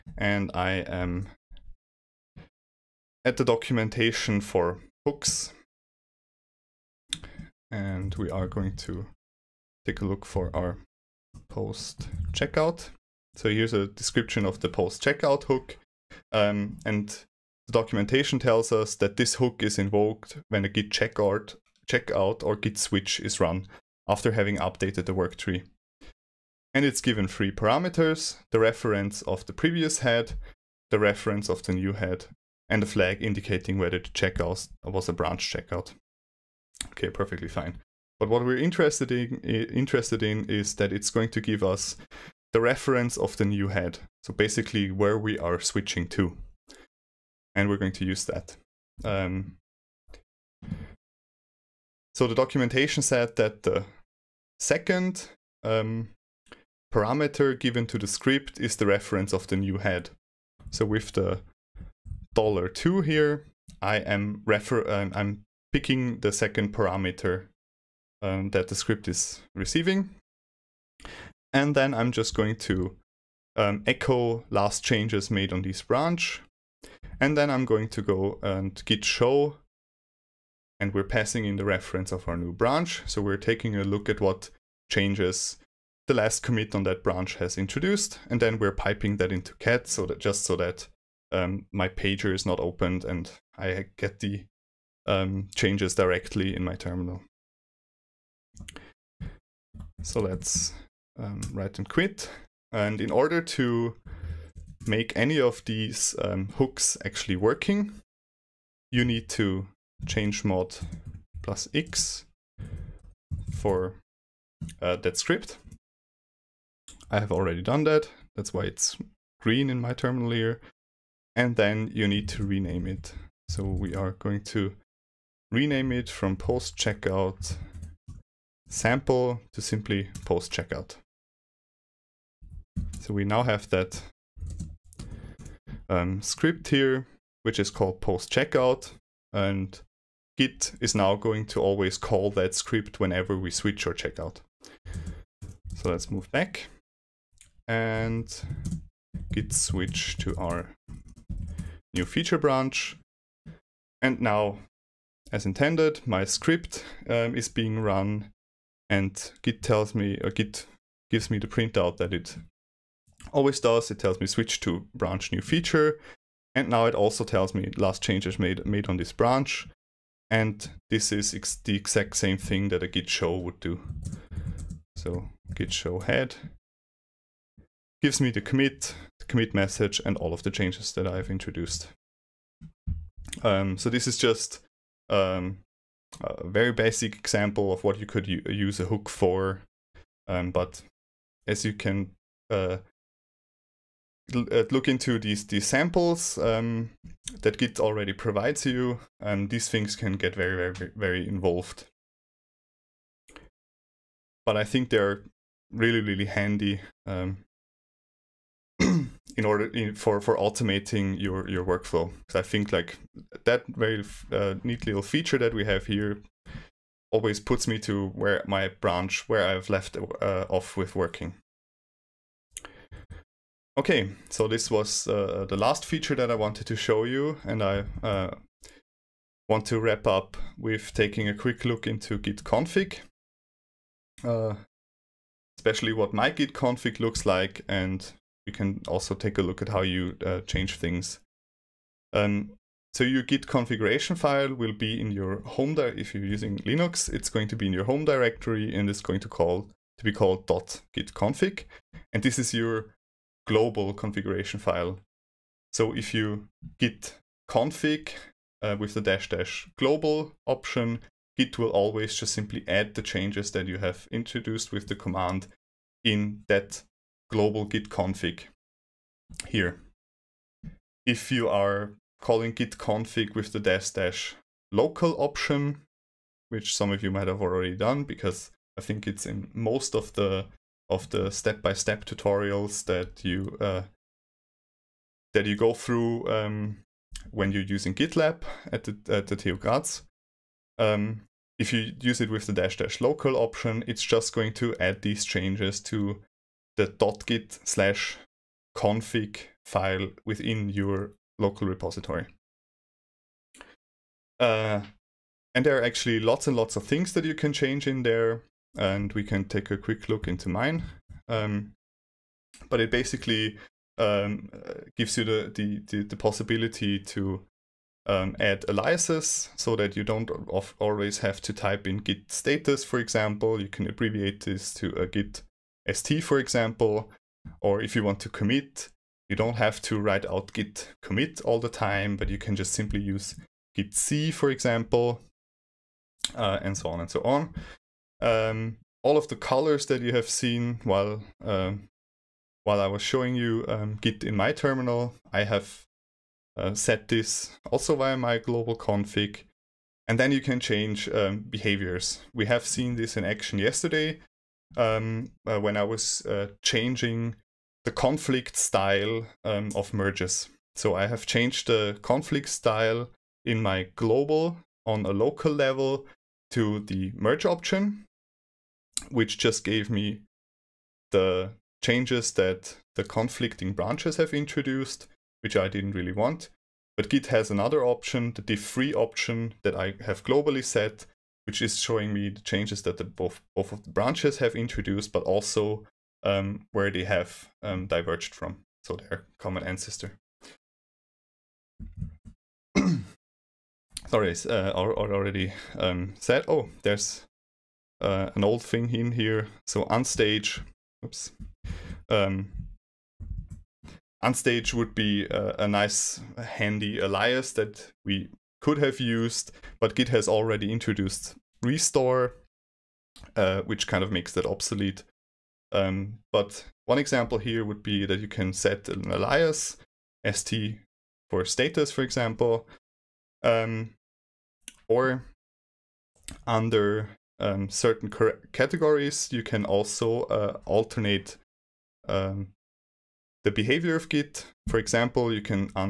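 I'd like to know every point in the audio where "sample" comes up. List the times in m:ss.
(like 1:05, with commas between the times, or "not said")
2:08, 3:15.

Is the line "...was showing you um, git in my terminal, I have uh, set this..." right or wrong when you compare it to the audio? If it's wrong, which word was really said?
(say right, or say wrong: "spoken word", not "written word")
right.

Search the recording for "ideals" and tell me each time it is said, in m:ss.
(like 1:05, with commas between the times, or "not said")
not said.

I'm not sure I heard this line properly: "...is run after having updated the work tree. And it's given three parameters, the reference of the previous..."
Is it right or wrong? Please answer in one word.
right.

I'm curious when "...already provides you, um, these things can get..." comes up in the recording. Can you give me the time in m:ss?
3:17.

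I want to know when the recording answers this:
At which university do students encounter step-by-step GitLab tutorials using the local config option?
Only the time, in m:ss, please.
4:49.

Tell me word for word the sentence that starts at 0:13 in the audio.
So here's a description of the post checkout hook.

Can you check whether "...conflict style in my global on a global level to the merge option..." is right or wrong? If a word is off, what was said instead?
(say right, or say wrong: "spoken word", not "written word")
wrong: "local", not "global".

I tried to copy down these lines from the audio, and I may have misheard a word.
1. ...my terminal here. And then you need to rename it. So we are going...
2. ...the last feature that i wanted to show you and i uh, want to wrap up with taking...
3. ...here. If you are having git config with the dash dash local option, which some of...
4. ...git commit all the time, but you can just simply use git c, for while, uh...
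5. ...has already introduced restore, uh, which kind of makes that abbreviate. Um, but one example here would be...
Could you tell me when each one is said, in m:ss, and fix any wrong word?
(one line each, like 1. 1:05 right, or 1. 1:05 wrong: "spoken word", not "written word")
1. 1:59 right
2. 3:45 right
3. 4:29 wrong: "calling", not "having"
4. 5:30 wrong: "example", not "while"
5. 6:50 wrong: "obsolete", not "abbreviate".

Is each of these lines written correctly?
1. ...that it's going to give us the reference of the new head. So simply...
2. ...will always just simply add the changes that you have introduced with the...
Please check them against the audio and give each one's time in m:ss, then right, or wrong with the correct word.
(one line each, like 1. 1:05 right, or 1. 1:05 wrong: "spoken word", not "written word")
1. 0:40 wrong: "basically", not "simply"
2. 4:21 right.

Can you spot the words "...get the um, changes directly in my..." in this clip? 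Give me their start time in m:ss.
1:33.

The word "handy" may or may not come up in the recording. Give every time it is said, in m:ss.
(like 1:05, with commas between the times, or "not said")
3:26, 6:46.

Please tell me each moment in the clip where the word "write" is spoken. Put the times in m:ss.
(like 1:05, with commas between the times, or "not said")
1:41, 5:29.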